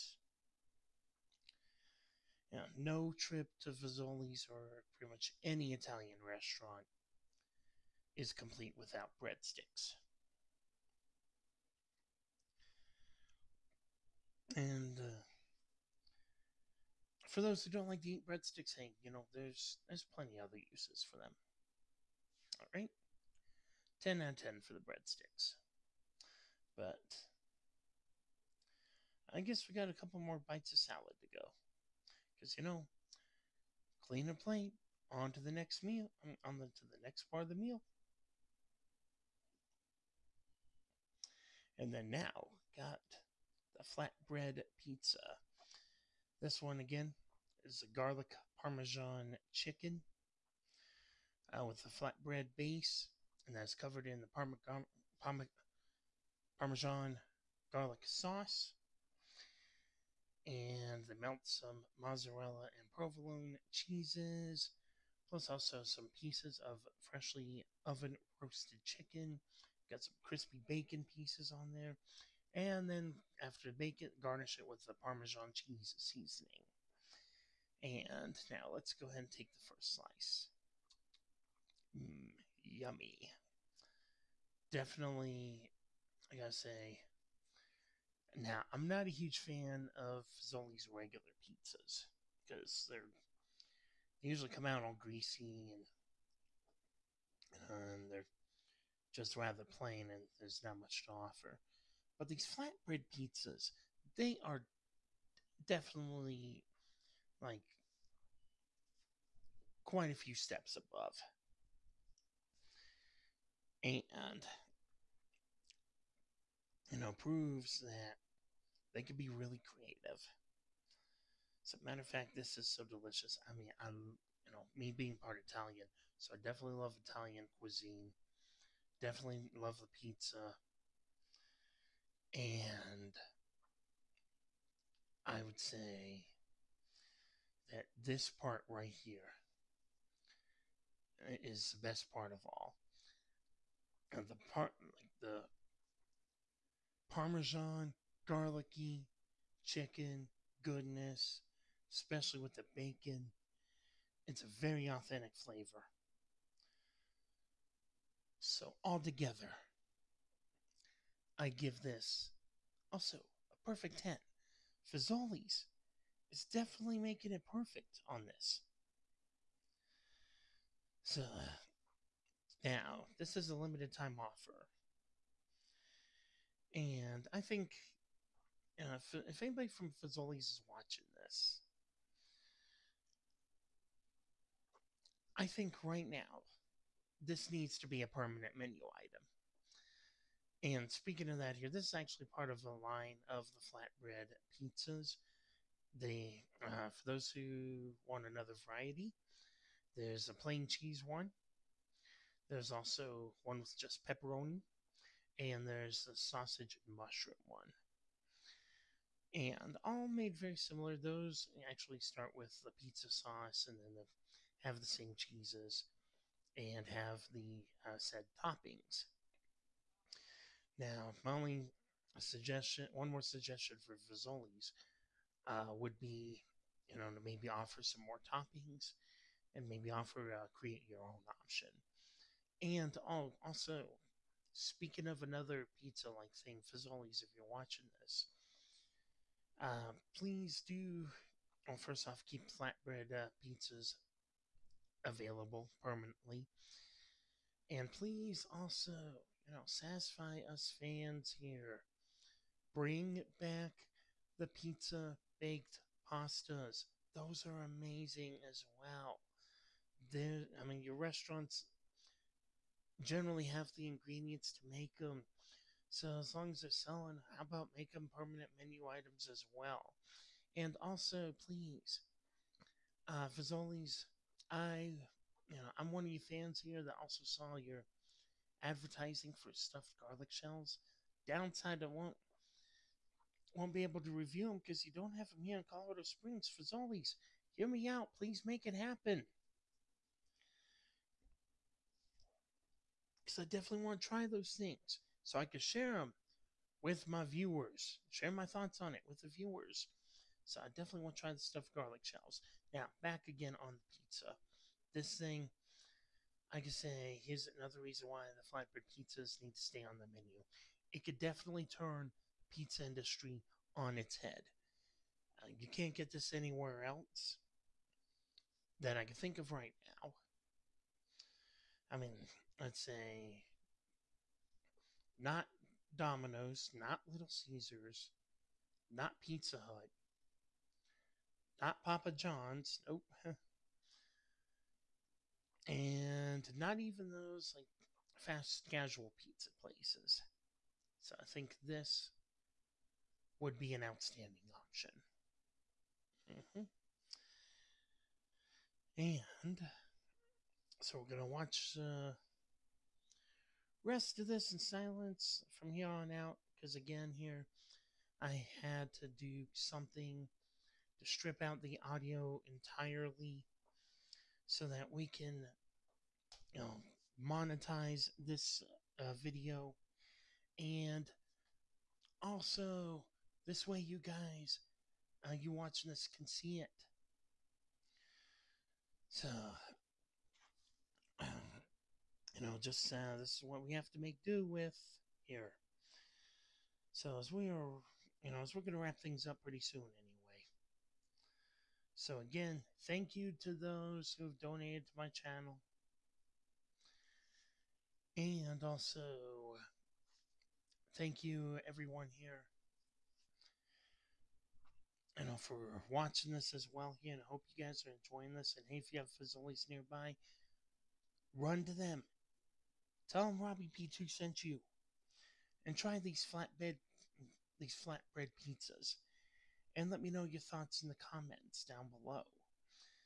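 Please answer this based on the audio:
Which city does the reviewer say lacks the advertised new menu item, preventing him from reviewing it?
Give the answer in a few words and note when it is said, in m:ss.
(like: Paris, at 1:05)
Colorado Springs, at 4:45.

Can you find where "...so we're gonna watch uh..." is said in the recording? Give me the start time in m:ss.
5:50.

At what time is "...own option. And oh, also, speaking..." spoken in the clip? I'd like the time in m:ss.
3:51.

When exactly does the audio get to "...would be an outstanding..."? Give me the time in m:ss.
5:43.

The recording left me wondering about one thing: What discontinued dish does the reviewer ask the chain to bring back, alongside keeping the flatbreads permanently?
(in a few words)
Pizza baked pastas.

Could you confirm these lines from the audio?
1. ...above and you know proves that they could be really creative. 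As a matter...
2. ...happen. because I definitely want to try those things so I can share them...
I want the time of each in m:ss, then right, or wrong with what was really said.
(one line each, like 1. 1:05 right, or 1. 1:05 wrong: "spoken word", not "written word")
1. 1:50 right
2. 4:48 right.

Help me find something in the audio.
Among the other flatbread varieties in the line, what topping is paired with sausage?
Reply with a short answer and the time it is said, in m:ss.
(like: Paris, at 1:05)
Mushroom, at 3:26.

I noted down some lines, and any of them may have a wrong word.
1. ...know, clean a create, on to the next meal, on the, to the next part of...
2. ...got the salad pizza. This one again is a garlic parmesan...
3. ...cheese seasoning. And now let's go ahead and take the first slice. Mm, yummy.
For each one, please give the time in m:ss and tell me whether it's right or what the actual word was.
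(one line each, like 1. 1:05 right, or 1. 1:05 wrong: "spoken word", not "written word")
1. 0:32 wrong: "plate", not "create"
2. 0:42 wrong: "flatbread", not "salad"
3. 1:15 right.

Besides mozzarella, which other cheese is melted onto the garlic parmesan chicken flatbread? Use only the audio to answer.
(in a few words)
Provolone.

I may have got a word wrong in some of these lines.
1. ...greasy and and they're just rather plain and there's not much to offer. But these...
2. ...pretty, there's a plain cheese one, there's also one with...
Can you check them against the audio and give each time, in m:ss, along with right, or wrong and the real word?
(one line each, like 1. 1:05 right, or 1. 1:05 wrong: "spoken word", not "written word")
1. 1:34 right
2. 3:18 wrong: "variety", not "pretty".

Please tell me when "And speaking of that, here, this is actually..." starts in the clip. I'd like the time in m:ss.
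3:10.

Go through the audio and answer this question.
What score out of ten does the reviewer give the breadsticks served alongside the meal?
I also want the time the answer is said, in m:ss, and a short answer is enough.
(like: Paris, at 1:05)
10, at 0:24.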